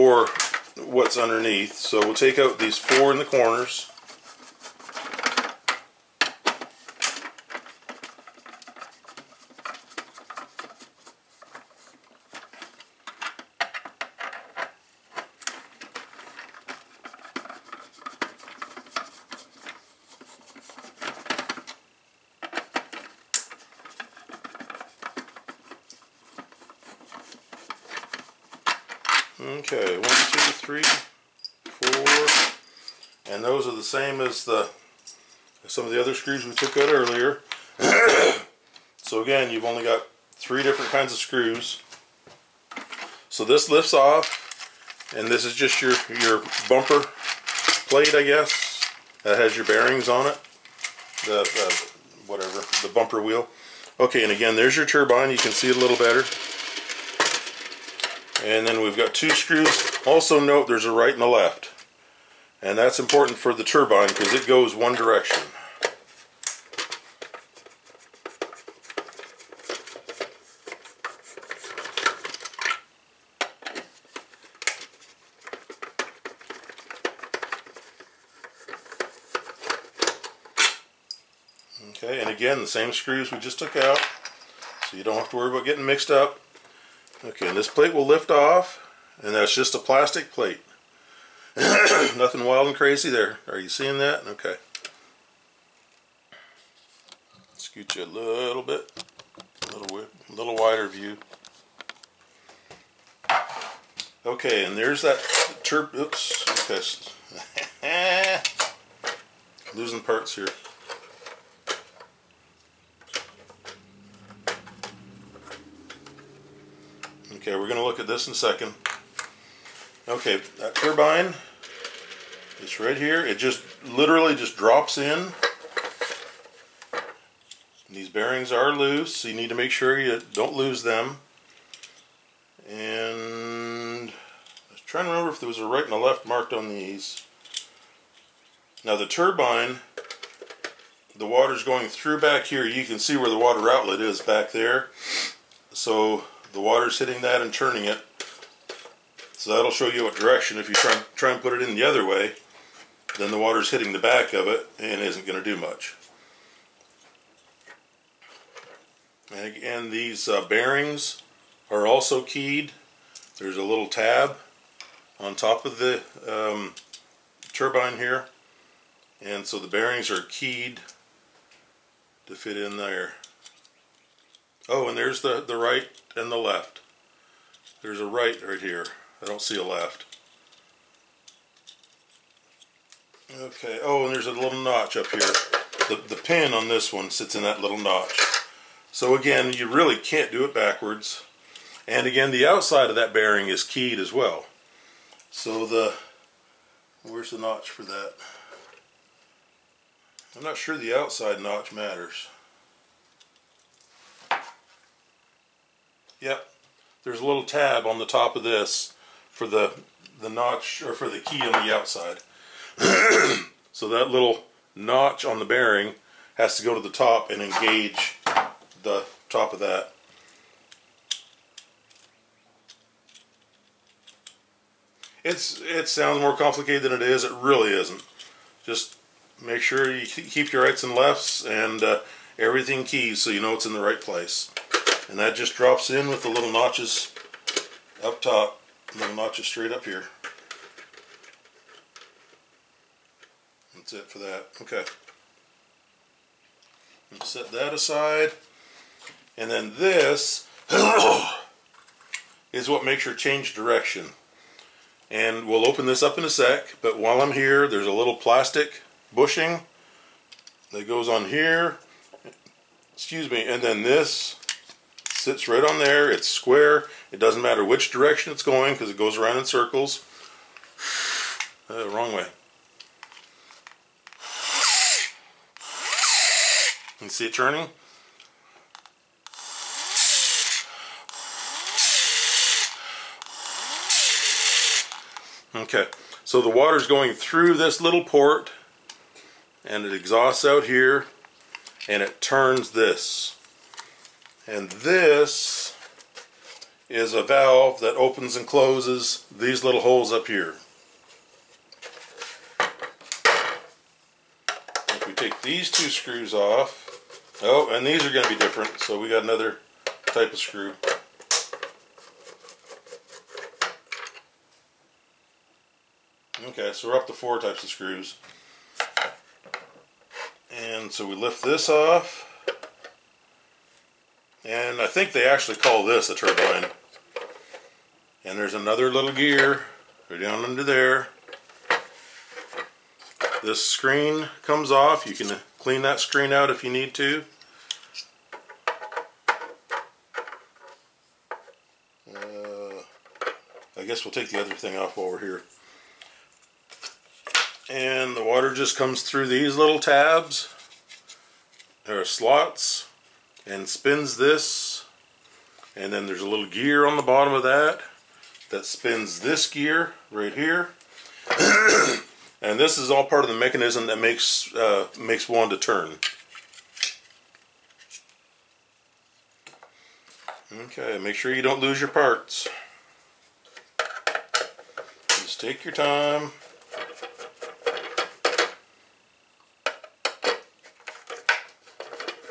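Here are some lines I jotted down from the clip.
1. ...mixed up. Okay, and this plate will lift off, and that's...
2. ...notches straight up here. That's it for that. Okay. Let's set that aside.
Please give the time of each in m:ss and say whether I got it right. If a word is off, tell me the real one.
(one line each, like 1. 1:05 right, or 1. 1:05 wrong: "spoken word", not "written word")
1. 1:25 right
2. 3:59 right.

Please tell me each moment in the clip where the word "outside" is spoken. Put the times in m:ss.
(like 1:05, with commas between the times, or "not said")
3:12, 3:20, 3:31.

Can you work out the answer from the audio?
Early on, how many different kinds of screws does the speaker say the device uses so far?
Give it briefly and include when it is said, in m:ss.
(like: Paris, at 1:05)
3, at 0:40.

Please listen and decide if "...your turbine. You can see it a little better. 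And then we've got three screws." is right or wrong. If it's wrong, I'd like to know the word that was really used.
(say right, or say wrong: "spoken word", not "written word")
wrong: "two", not "three".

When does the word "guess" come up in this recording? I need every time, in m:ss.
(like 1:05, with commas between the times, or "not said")
0:48, 5:43.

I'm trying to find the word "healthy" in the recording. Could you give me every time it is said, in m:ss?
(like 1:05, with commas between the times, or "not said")
not said.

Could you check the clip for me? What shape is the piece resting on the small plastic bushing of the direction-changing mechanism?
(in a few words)
Square.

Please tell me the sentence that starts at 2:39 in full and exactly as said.
And again, these uh, bearings are also keyed.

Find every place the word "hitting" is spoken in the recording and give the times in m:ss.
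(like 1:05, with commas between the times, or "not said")
2:26, 2:33.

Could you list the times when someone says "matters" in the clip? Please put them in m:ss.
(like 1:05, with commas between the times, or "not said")
3:21, 4:27.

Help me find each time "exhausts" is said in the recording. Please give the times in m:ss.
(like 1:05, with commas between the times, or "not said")
4:49.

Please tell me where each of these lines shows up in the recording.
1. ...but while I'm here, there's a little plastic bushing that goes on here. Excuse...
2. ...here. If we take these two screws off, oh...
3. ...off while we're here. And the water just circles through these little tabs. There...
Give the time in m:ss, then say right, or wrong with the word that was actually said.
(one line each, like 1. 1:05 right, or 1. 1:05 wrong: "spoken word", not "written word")
1. 4:16 right
2. 5:00 right
3. 5:44 wrong: "comes", not "circles".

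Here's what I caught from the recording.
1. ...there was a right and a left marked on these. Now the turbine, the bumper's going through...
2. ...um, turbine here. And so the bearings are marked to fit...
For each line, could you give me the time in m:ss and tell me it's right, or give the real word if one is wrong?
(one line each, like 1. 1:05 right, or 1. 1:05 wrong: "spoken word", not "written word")
1. 2:15 wrong: "water", not "bumper"
2. 2:46 wrong: "keyed", not "marked".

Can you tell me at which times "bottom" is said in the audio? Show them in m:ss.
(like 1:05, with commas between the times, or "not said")
5:57.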